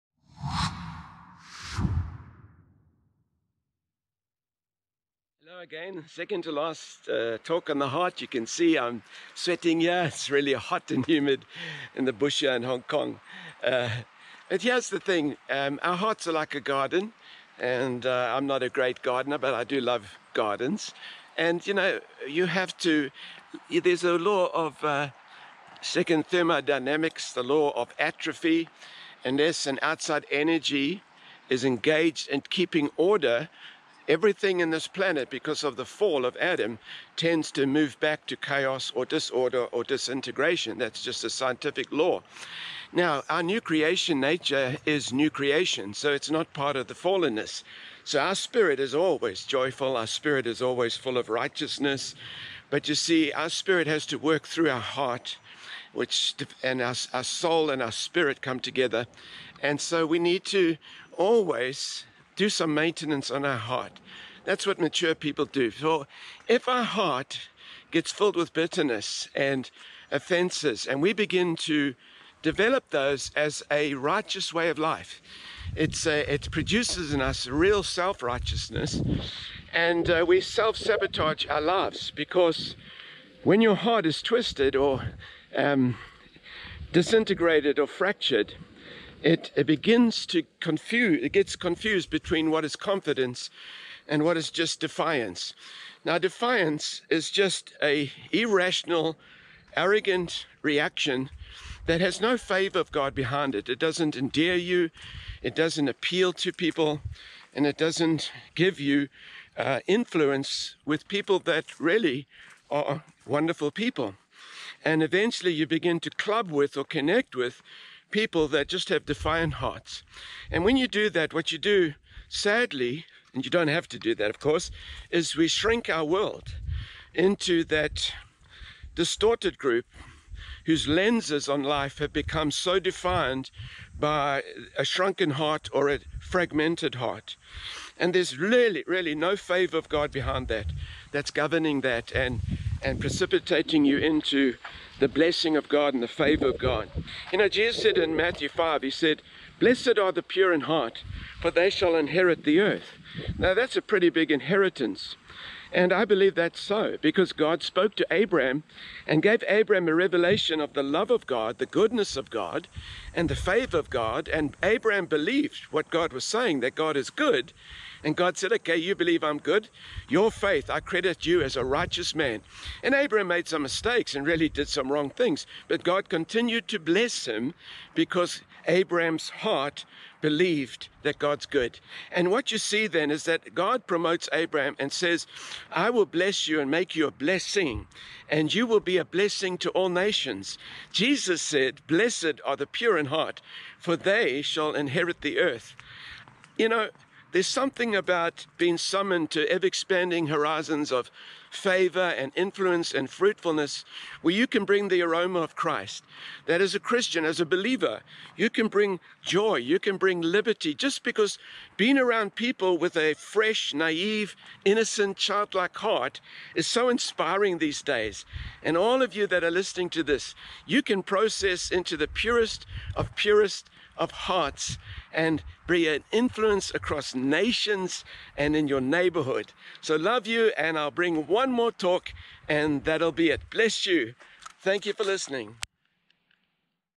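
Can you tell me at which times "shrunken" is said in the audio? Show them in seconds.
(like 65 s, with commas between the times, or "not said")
134 s.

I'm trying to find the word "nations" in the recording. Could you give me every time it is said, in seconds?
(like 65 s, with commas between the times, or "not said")
189 s, 227 s.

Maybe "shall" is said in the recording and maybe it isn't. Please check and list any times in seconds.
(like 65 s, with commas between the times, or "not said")
151 s, 194 s.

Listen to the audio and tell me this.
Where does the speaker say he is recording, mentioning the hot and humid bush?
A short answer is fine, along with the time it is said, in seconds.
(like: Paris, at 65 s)
Hong Kong, at 12 s.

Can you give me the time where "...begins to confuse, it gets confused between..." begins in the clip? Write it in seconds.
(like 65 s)
89 s.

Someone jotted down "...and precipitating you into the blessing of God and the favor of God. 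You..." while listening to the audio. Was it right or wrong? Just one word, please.
right.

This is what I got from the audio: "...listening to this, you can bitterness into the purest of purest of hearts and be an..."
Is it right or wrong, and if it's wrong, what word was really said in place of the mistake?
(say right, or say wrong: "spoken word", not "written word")
wrong: "process", not "bitterness".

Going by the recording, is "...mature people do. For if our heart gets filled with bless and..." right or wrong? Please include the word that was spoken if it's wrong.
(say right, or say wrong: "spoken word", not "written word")
wrong: "bitterness", not "bless".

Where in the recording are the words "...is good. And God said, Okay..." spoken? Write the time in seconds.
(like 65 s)
166 s.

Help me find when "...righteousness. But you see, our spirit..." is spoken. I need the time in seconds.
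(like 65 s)
51 s.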